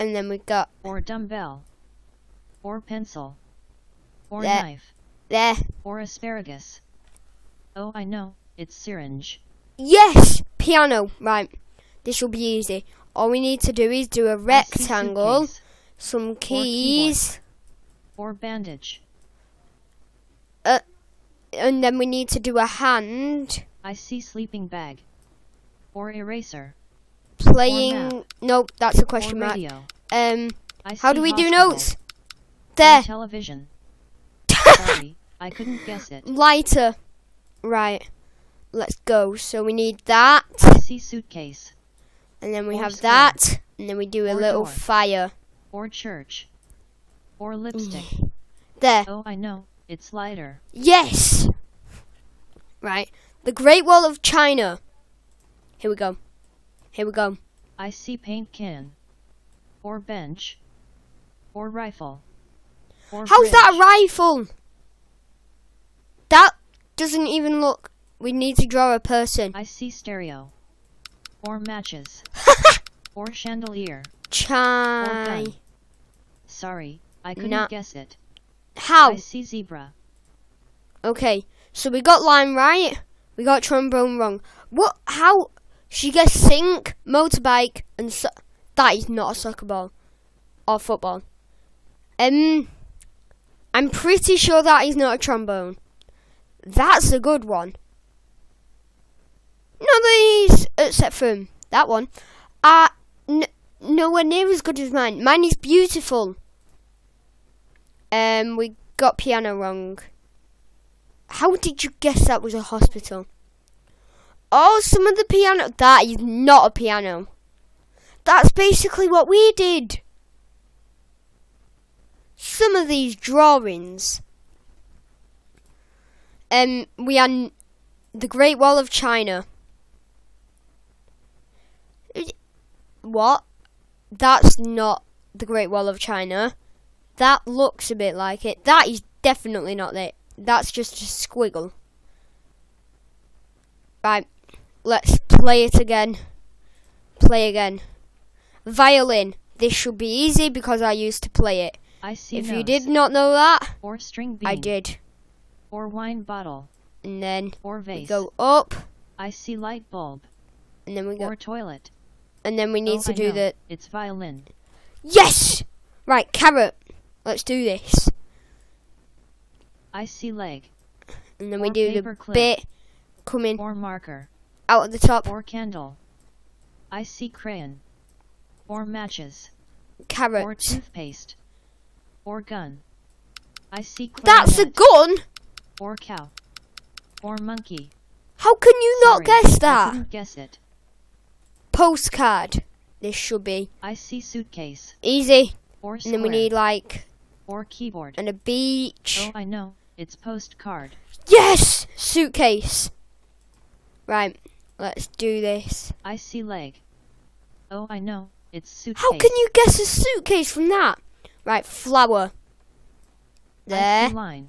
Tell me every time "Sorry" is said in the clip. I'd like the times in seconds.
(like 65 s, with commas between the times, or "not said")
34 s, 76 s, 189 s.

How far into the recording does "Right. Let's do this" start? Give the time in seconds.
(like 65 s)
204 s.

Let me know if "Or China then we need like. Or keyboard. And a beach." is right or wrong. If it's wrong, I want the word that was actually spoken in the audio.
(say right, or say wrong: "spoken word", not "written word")
wrong: "And", not "China".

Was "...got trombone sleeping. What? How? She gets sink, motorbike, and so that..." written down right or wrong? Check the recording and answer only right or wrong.
wrong.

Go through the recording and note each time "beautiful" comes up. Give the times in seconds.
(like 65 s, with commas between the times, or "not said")
105 s.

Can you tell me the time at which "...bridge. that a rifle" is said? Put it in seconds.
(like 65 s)
63 s.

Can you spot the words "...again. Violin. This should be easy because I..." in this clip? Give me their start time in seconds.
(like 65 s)
147 s.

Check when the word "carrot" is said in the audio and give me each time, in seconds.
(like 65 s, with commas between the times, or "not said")
166 s, 180 s.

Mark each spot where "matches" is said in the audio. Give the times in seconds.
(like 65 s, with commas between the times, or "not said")
71 s, 178 s.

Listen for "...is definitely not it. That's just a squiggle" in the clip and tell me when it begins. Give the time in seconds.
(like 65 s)
138 s.